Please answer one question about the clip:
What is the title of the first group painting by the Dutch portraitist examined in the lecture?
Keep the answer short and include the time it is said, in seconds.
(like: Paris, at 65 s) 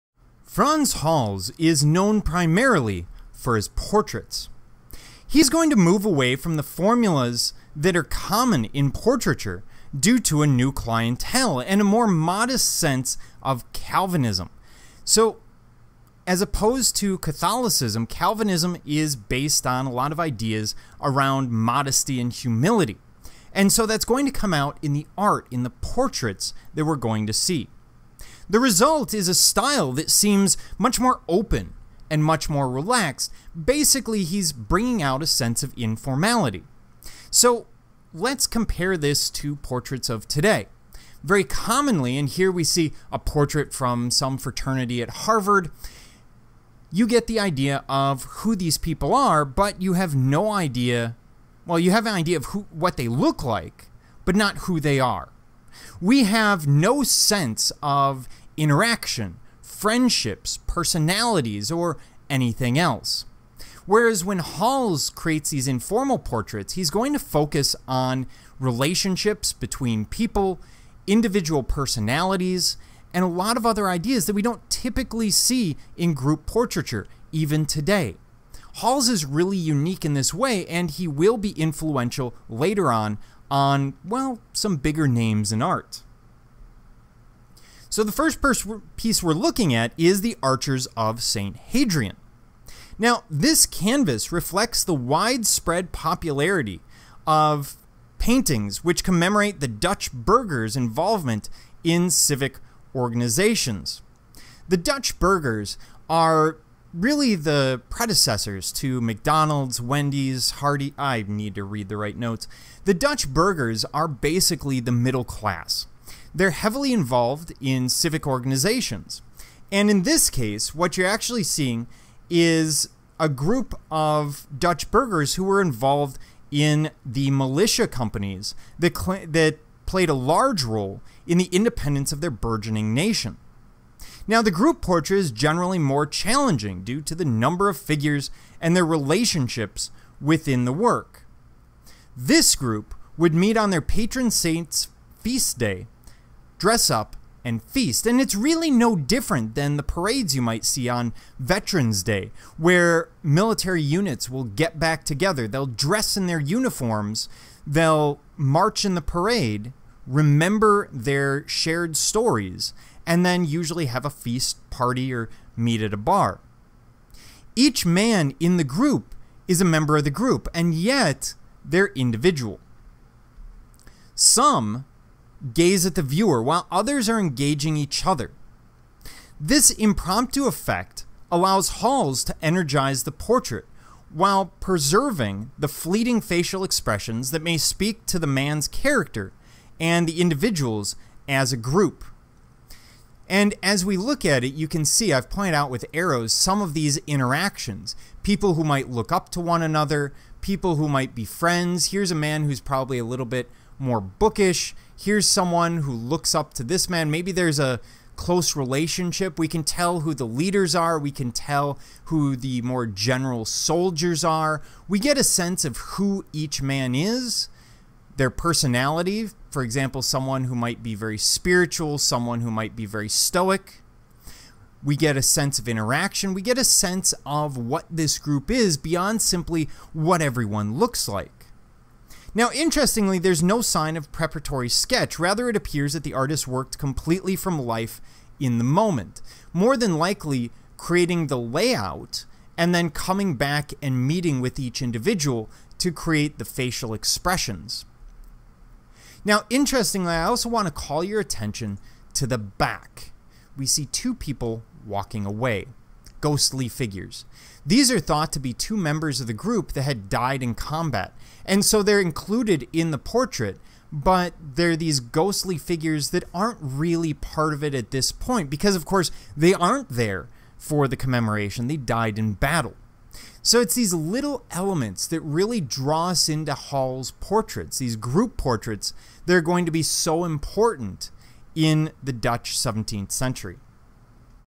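Archers of St. Hadrian, at 90 s.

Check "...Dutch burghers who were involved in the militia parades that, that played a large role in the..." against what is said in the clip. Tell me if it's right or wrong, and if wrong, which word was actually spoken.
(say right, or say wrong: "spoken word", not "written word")
wrong: "companies", not "parades".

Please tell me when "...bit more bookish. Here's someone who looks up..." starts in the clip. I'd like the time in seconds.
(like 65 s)
203 s.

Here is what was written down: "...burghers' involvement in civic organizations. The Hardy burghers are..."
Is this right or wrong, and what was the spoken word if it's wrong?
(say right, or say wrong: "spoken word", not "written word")
wrong: "Dutch", not "Hardy".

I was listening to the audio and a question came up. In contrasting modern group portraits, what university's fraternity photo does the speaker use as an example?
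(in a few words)
Harvard.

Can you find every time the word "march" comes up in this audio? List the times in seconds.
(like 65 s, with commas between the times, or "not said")
158 s.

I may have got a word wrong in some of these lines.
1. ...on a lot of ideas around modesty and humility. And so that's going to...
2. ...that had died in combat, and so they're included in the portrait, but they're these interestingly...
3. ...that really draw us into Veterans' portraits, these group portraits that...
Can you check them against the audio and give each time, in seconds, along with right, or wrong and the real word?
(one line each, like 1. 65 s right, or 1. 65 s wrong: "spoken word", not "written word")
1. 19 s right
2. 259 s wrong: "ghostly", not "interestingly"
3. 275 s wrong: "Hals", not "Veterans".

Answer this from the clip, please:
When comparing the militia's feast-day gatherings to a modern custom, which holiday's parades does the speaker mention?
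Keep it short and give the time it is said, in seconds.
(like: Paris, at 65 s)
Veterans Day, at 151 s.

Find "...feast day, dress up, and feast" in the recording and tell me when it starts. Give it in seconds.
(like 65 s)
145 s.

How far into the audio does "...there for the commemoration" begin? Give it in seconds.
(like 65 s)
269 s.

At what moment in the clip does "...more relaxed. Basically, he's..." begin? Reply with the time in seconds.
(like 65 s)
32 s.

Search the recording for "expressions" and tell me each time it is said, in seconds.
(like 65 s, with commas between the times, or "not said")
186 s, 246 s.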